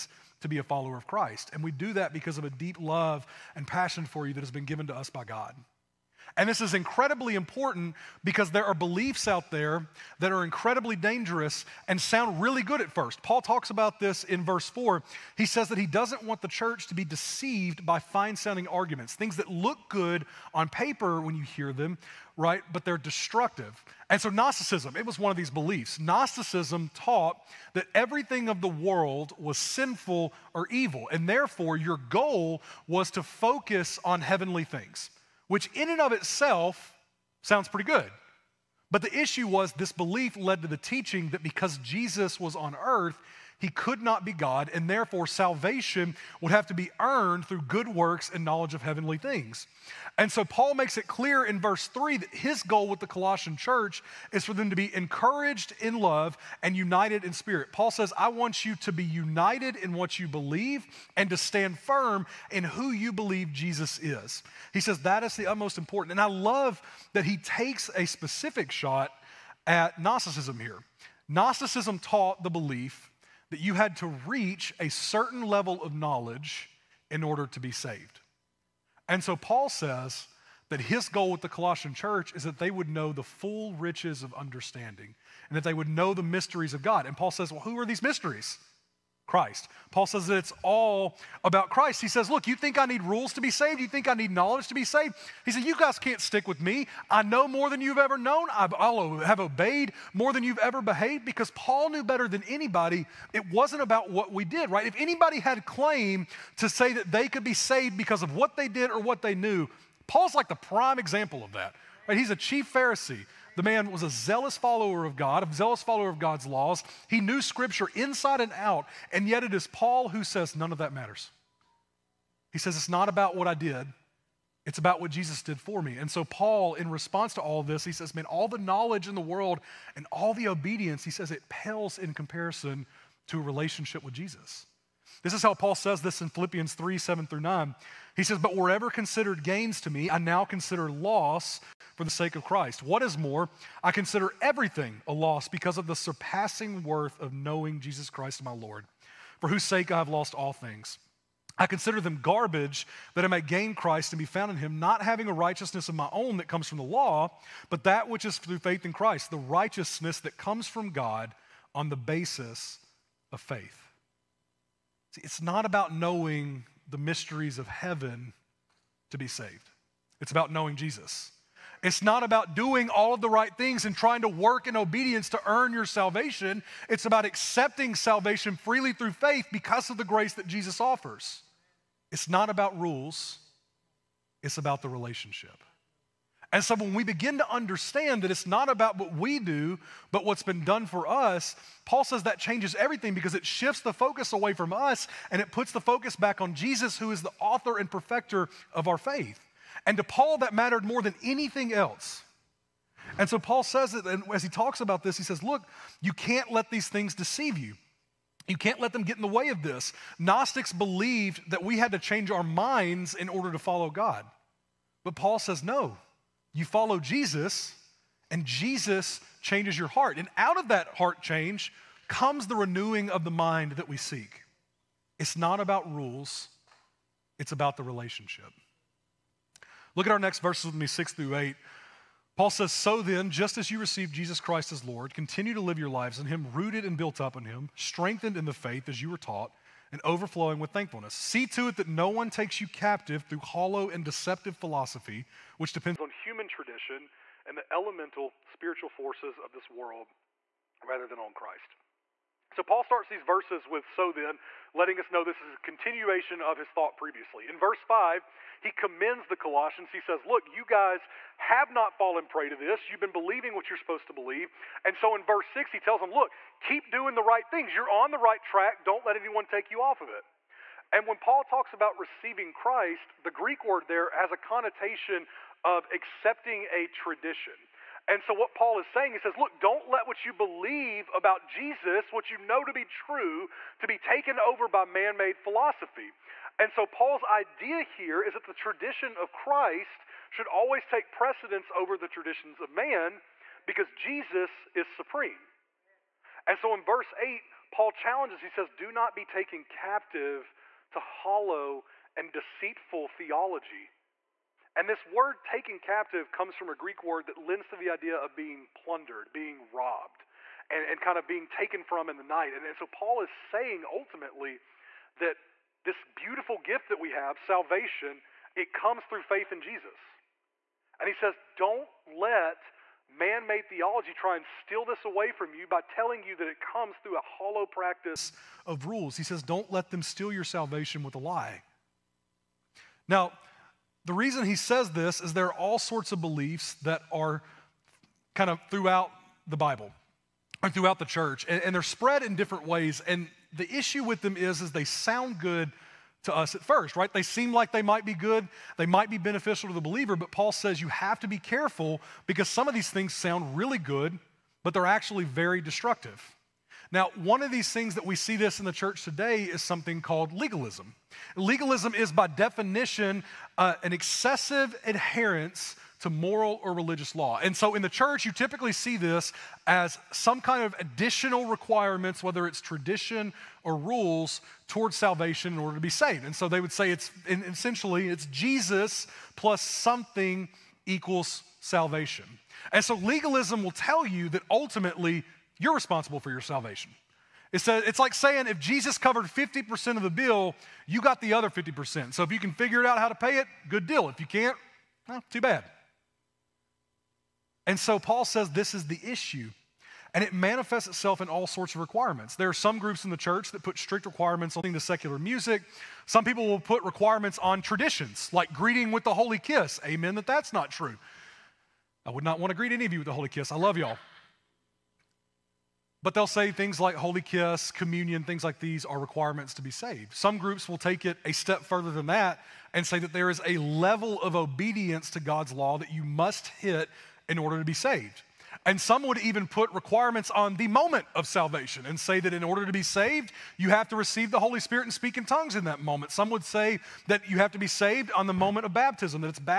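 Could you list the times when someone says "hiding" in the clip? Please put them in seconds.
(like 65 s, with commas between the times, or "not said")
not said.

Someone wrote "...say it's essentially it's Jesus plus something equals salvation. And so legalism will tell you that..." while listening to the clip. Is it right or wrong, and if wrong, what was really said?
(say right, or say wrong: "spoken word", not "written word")
right.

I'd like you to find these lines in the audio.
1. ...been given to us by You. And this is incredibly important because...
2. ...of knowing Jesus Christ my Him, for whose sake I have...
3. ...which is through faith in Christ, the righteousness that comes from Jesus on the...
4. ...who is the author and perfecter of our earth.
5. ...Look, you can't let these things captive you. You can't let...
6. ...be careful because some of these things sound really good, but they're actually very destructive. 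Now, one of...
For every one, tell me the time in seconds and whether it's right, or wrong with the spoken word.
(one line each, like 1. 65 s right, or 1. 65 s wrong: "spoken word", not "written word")
1. 4 s wrong: "God", not "You"
2. 147 s wrong: "Lord", not "Him"
3. 158 s wrong: "God", not "Jesus"
4. 196 s wrong: "faith", not "earth"
5. 205 s wrong: "deceive", not "captive"
6. 351 s right.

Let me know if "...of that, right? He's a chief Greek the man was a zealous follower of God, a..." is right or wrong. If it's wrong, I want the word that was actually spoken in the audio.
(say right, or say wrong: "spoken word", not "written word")
wrong: "Pharisee", not "Greek".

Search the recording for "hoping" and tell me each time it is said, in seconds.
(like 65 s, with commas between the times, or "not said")
not said.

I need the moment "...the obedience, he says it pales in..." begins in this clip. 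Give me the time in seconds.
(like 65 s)
130 s.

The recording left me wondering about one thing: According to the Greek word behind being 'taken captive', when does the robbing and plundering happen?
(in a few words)
In the night.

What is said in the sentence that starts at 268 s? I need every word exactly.
Don't let anyone take you off of it.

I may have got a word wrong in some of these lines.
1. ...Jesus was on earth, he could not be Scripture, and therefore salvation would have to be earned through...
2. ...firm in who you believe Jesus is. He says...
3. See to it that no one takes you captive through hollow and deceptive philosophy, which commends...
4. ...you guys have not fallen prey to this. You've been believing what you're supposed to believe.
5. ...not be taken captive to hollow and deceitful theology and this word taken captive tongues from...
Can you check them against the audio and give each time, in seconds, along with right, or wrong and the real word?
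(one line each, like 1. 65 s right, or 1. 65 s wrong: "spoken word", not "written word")
1. 41 s wrong: "God", not "Scripture"
2. 61 s right
3. 241 s wrong: "depends", not "commends"
4. 260 s right
5. 298 s wrong: "comes", not "tongues".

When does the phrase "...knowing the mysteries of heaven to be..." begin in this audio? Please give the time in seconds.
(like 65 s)
165 s.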